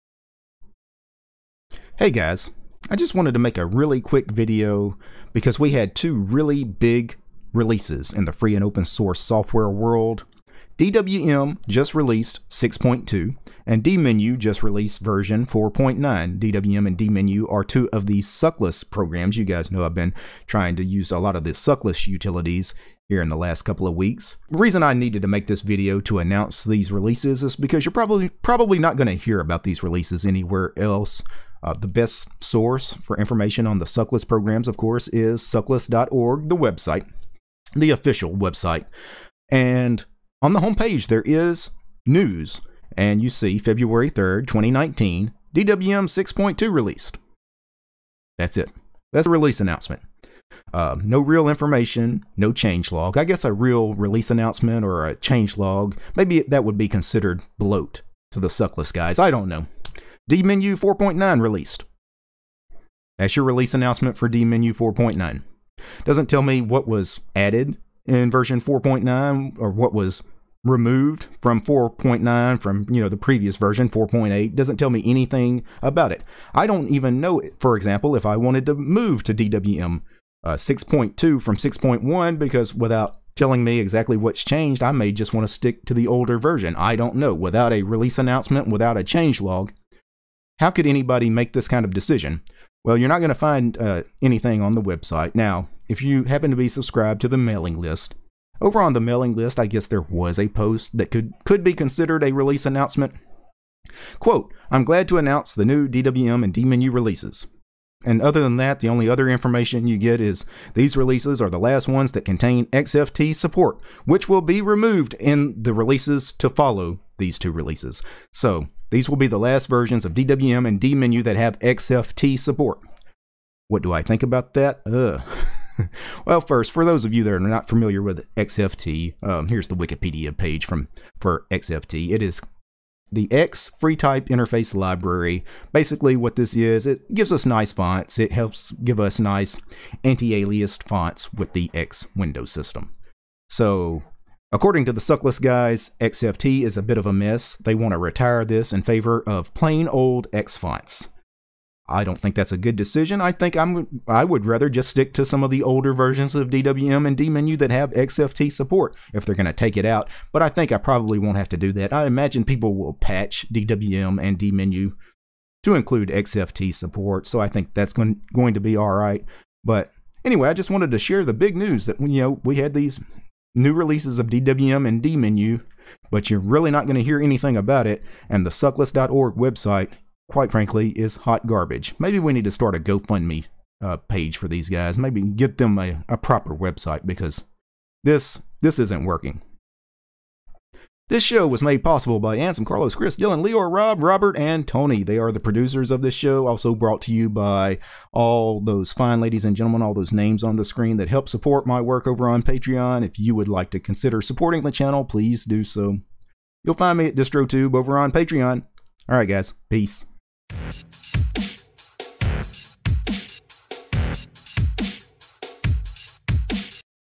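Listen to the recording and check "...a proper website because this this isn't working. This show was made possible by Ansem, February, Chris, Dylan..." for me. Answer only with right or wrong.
wrong.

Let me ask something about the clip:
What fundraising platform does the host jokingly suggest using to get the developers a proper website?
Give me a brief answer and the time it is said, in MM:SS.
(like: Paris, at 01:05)
GoFundMe, at 03:02.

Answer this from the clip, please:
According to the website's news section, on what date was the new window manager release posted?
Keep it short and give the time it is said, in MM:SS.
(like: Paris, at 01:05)
February 3rd, 2019, at 00:43.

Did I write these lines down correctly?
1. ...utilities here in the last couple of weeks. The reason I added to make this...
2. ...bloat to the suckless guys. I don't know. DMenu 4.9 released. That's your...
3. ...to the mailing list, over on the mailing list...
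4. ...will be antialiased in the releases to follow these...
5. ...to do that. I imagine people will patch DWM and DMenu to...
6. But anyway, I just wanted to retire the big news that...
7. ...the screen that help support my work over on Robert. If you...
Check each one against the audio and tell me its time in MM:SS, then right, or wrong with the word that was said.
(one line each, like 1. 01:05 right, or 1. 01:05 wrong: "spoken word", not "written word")
1. 00:22 wrong: "needed", not "added"
2. 00:57 right
3. 01:37 right
4. 01:54 wrong: "removed", not "antialiased"
5. 02:41 right
6. 02:49 wrong: "share", not "retire"
7. 03:20 wrong: "Patreon", not "Robert".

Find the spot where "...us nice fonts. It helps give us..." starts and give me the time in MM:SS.
02:17.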